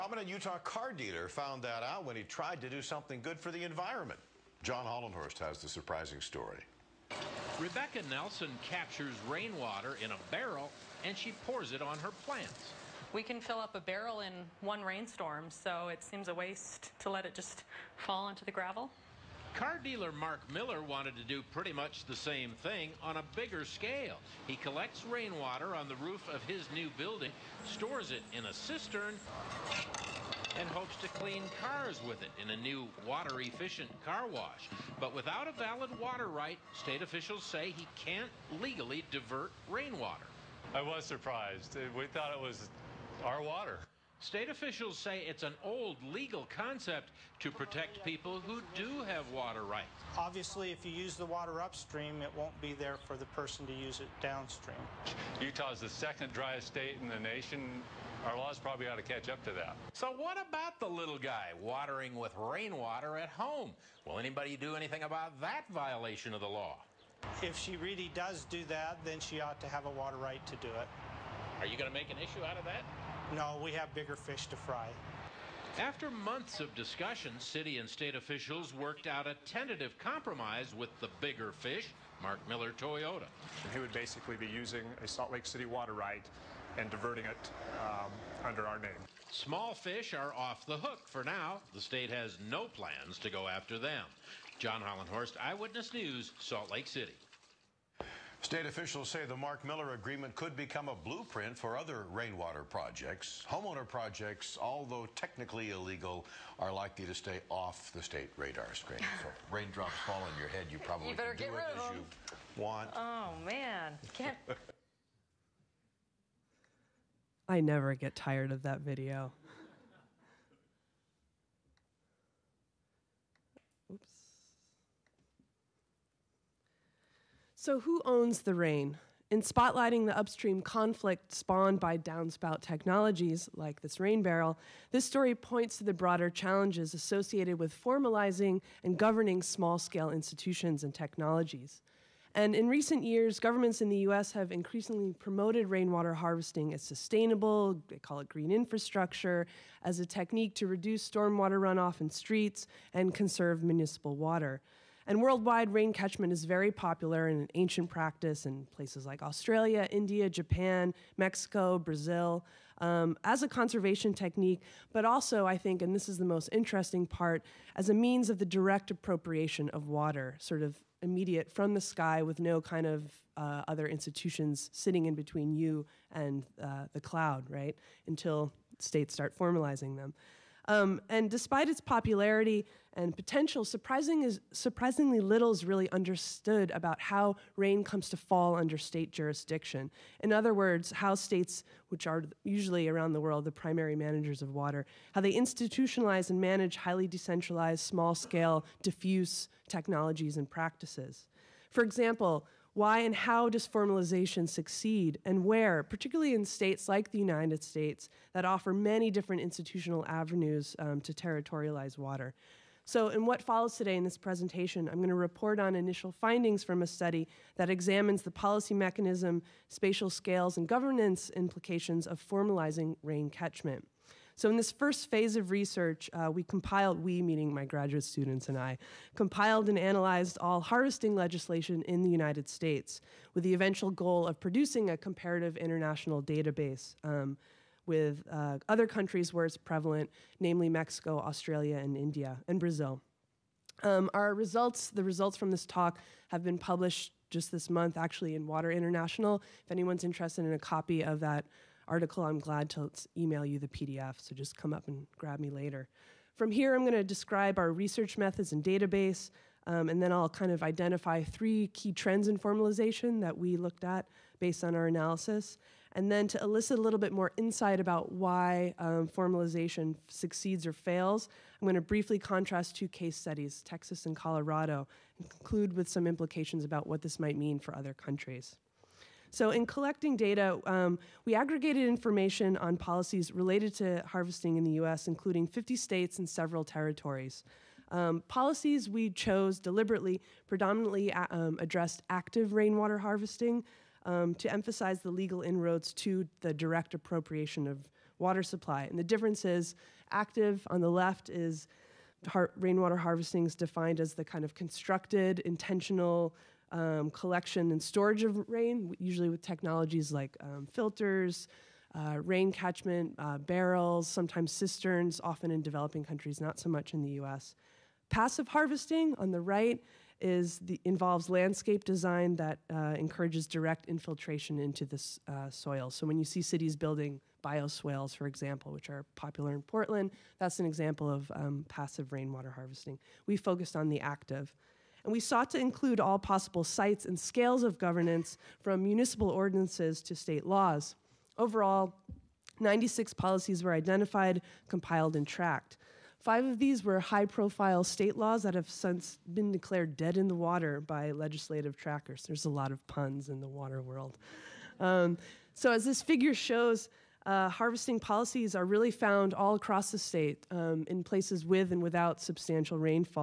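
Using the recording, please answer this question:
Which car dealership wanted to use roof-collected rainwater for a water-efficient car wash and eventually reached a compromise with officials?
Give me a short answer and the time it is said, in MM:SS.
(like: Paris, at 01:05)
Mark Miller Toyota, at 01:22.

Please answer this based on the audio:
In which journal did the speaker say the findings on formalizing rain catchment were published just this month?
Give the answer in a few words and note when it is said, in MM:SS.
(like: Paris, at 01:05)
Water International, at 04:08.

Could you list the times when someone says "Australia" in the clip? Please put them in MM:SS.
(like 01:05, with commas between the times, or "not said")
02:39, 04:01.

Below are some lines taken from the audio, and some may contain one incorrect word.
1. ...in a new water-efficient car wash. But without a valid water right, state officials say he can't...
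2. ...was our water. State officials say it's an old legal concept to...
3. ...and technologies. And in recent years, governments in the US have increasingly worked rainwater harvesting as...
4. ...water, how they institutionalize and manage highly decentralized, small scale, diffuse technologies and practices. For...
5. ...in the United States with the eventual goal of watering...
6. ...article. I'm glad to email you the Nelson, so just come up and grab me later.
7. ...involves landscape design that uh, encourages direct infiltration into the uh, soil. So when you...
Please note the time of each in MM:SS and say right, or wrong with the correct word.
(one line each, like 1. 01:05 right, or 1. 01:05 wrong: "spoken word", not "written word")
1. 00:32 right
2. 00:42 right
3. 02:20 wrong: "promoted", not "worked"
4. 03:14 right
5. 03:51 wrong: "producing", not "watering"
6. 04:11 wrong: "PDF", not "Nelson"
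7. 05:20 right.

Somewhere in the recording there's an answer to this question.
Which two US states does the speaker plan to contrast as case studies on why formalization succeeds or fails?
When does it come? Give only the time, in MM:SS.
04:33.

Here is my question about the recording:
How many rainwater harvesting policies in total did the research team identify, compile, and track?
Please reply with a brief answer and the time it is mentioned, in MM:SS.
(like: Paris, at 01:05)
96, at 05:42.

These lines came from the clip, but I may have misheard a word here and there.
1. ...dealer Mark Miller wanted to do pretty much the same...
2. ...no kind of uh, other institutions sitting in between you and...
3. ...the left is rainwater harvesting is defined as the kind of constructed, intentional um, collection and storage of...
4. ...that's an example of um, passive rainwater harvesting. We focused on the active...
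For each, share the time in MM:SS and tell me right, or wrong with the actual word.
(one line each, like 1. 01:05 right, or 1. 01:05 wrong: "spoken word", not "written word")
1. 00:19 right
2. 02:52 right
3. 05:00 right
4. 05:30 right.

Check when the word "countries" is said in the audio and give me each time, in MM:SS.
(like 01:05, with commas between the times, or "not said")
03:58, 04:37, 05:16.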